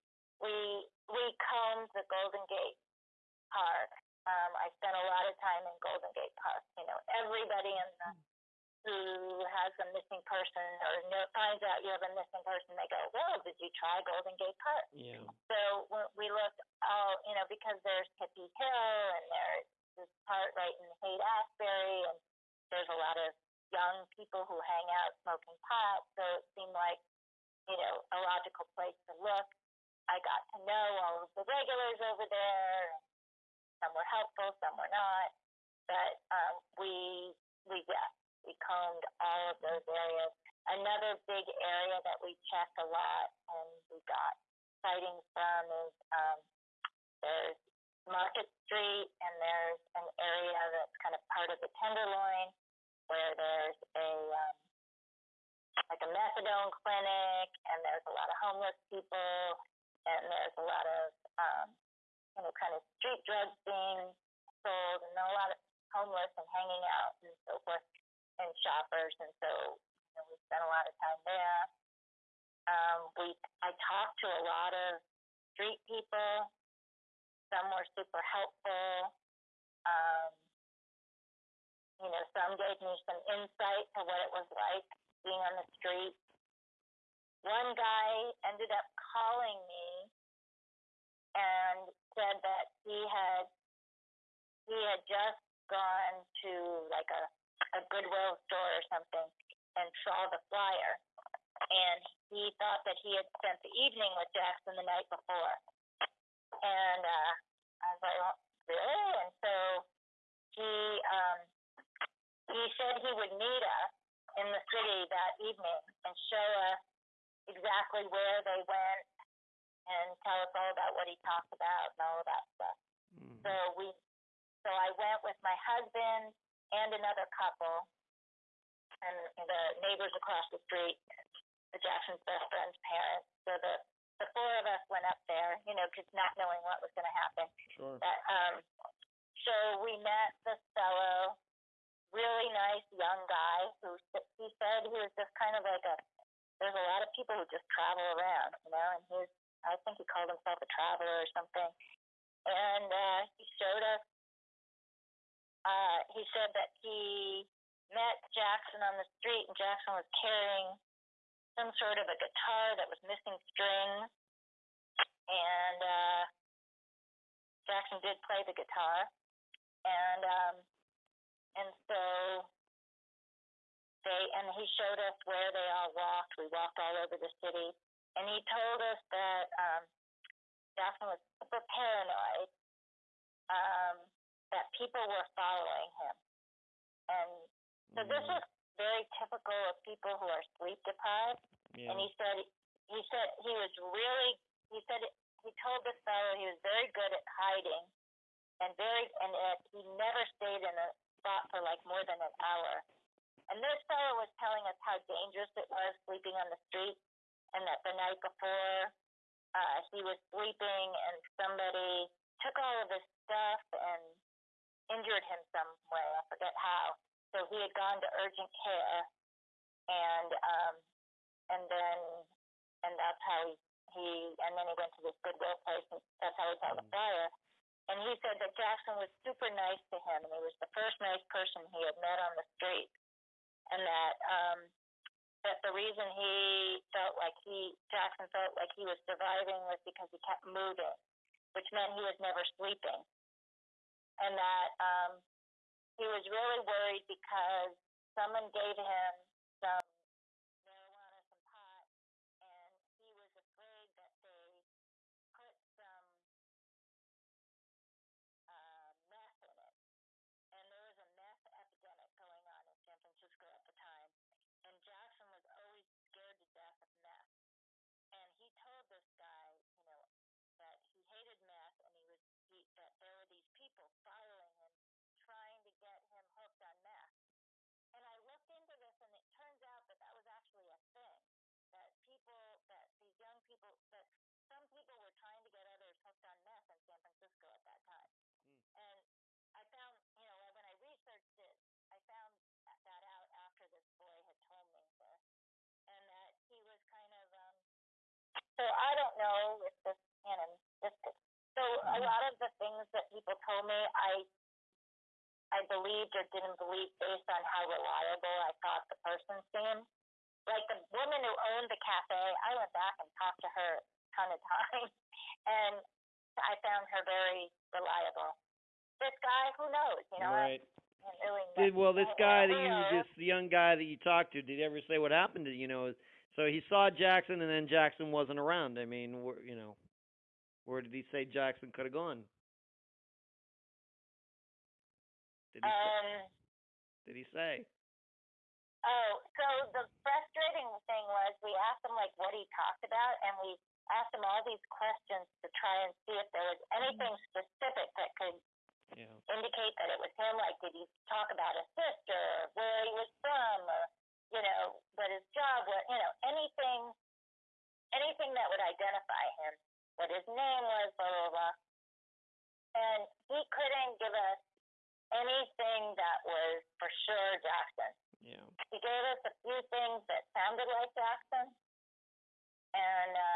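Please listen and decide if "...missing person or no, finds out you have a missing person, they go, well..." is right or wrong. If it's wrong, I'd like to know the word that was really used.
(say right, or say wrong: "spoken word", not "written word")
right.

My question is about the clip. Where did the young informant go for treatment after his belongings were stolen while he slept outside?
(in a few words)
urgent care.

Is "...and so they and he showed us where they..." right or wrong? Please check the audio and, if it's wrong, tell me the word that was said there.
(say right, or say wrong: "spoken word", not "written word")
right.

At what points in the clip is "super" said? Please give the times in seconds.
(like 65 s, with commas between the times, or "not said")
77 s, 181 s, 229 s.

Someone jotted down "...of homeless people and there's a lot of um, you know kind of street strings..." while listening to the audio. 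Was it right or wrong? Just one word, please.
wrong.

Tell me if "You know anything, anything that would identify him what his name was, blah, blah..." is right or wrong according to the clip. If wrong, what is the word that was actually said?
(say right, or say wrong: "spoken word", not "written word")
right.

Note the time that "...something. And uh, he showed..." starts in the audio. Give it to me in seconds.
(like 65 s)
151 s.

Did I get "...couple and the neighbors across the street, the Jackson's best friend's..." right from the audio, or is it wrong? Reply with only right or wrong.
right.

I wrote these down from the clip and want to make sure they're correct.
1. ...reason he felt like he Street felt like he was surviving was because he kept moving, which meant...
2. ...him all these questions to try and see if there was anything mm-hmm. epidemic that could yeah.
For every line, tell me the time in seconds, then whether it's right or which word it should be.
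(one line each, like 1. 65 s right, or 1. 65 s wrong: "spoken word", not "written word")
1. 235 s wrong: "Jackson", not "Street"
2. 344 s wrong: "specific", not "epidemic".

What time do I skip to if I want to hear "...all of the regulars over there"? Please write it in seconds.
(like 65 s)
31 s.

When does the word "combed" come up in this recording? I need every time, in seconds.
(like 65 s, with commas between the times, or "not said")
1 s, 38 s.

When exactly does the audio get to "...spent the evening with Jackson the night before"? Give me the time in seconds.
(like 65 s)
103 s.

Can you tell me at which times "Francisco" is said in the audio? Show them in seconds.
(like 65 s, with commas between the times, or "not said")
263 s, 287 s.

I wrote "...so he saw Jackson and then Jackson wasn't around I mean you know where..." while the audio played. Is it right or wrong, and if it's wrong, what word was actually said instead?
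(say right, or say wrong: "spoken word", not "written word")
right.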